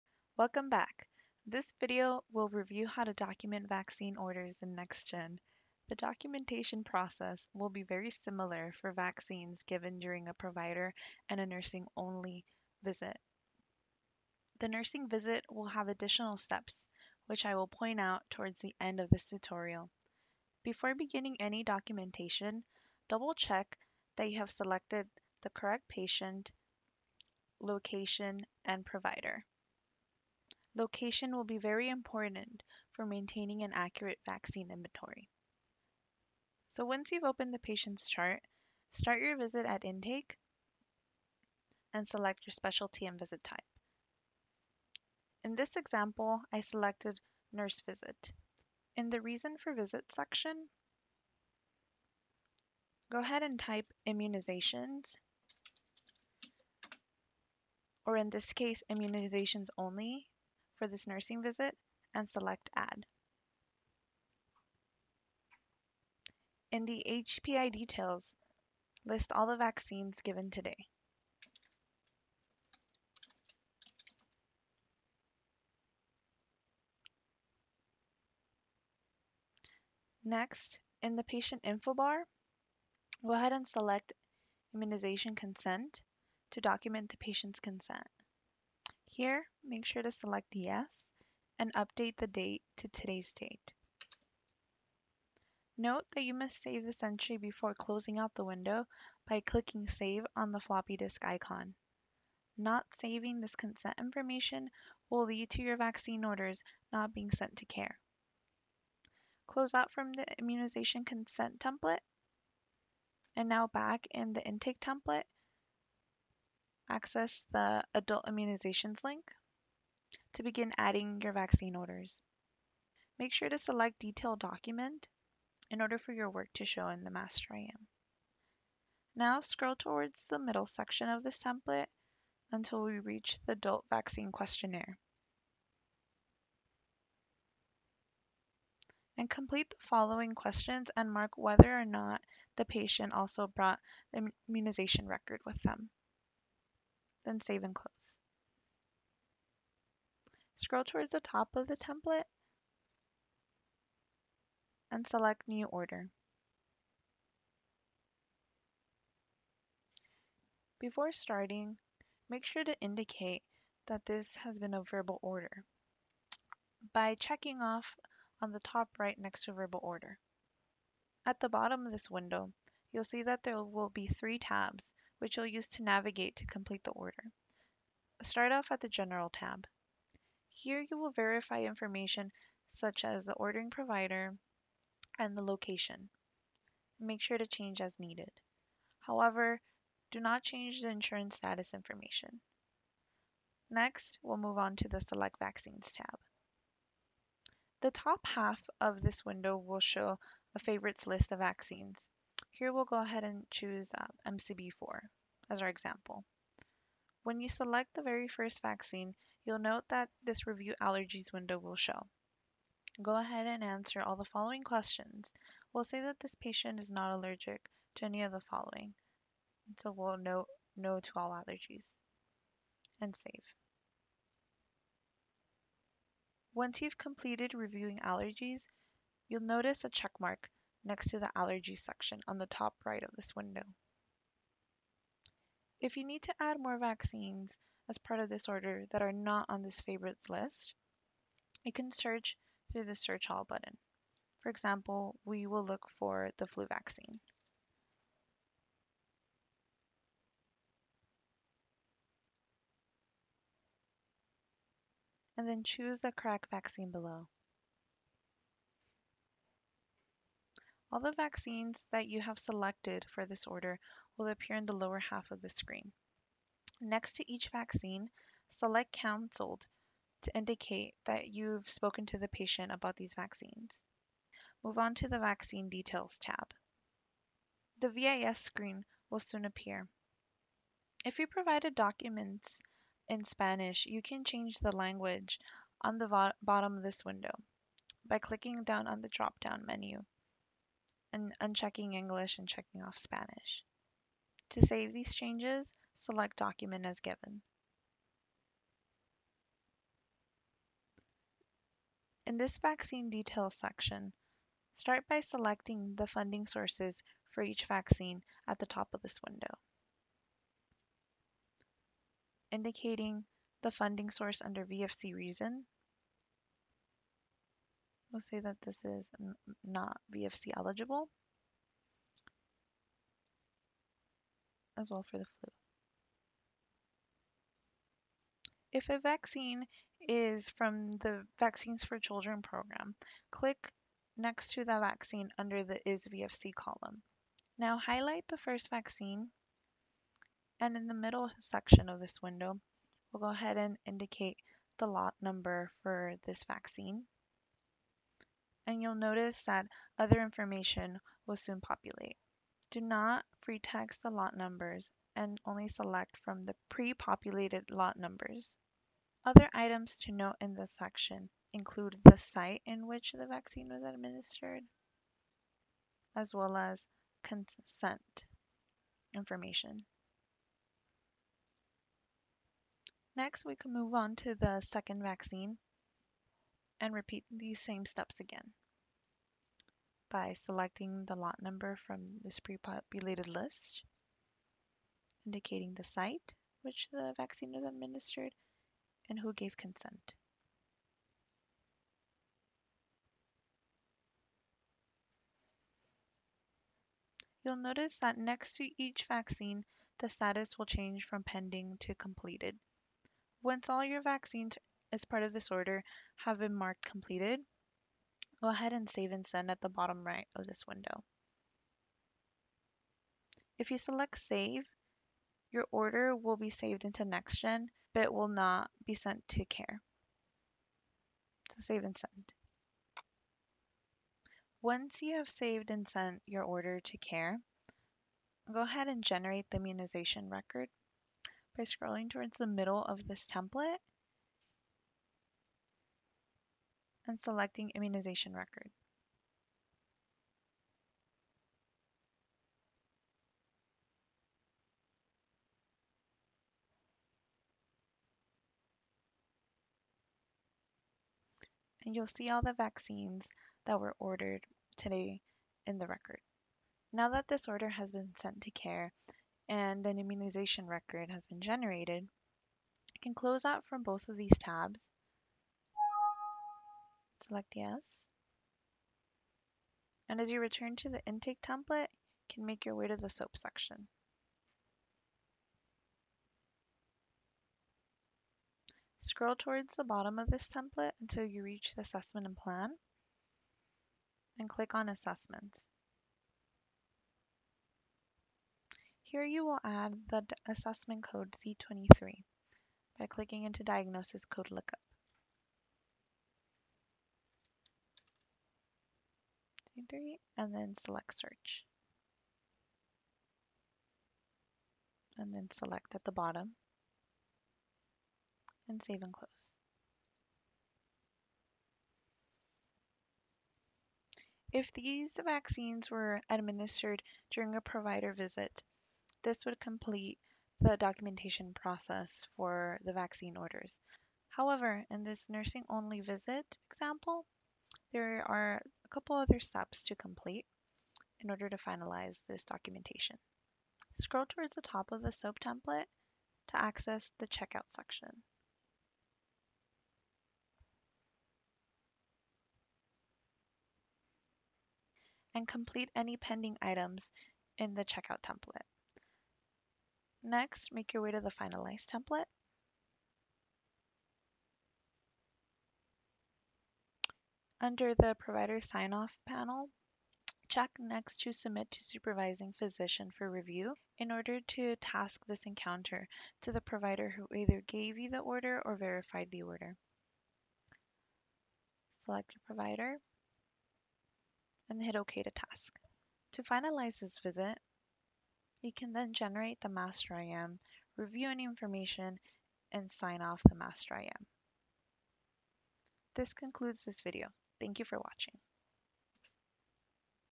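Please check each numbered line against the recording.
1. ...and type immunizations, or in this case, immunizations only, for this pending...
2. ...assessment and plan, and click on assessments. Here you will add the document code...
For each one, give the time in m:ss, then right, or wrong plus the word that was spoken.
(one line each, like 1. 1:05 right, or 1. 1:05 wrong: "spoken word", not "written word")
1. 0:53 wrong: "nursing", not "pending"
2. 8:01 wrong: "assessment", not "document".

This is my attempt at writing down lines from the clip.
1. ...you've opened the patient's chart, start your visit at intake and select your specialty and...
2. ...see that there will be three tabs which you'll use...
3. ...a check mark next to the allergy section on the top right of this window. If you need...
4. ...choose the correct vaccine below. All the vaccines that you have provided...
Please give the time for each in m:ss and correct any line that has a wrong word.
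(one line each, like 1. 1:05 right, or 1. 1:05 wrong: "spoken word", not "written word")
1. 0:37 right
2. 2:53 right
3. 3:49 right
4. 4:15 wrong: "selected", not "provided".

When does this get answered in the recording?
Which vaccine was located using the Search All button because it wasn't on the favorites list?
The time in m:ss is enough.
4:06.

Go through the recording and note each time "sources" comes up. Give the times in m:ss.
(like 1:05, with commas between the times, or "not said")
5:06, 5:14.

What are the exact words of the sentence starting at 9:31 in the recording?
Select your provider and hit OK to task.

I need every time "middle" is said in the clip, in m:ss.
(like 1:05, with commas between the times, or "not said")
2:10, 5:40, 7:12.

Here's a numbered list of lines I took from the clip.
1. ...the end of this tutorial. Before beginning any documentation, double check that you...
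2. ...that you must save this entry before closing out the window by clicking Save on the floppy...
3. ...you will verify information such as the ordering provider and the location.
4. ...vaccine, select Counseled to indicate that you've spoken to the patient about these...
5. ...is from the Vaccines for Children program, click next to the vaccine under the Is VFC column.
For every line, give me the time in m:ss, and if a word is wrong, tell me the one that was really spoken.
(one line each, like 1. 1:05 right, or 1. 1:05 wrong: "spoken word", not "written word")
1. 0:18 right
2. 1:36 right
3. 3:00 right
4. 4:27 right
5. 5:30 right.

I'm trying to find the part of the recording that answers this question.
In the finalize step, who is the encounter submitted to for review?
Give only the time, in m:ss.
9:21.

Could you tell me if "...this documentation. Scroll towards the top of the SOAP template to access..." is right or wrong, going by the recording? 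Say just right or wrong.
right.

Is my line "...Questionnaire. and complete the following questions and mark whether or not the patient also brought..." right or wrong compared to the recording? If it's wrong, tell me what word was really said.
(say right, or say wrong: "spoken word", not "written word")
right.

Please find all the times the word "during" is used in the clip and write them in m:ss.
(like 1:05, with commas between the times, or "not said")
0:09, 8:37.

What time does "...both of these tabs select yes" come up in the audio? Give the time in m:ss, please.
7:43.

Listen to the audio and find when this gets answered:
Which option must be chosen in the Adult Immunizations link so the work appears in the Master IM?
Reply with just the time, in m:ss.
2:03.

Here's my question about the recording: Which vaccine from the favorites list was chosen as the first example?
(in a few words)
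MCV4.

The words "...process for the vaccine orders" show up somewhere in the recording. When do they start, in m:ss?
8:41.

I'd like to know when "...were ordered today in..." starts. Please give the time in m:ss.
7:33.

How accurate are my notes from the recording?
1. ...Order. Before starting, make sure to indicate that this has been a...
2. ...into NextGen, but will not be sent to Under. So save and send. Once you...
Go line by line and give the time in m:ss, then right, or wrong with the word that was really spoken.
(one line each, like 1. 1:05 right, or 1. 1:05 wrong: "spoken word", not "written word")
1. 2:35 right
2. 6:56 wrong: "CAIR", not "Under".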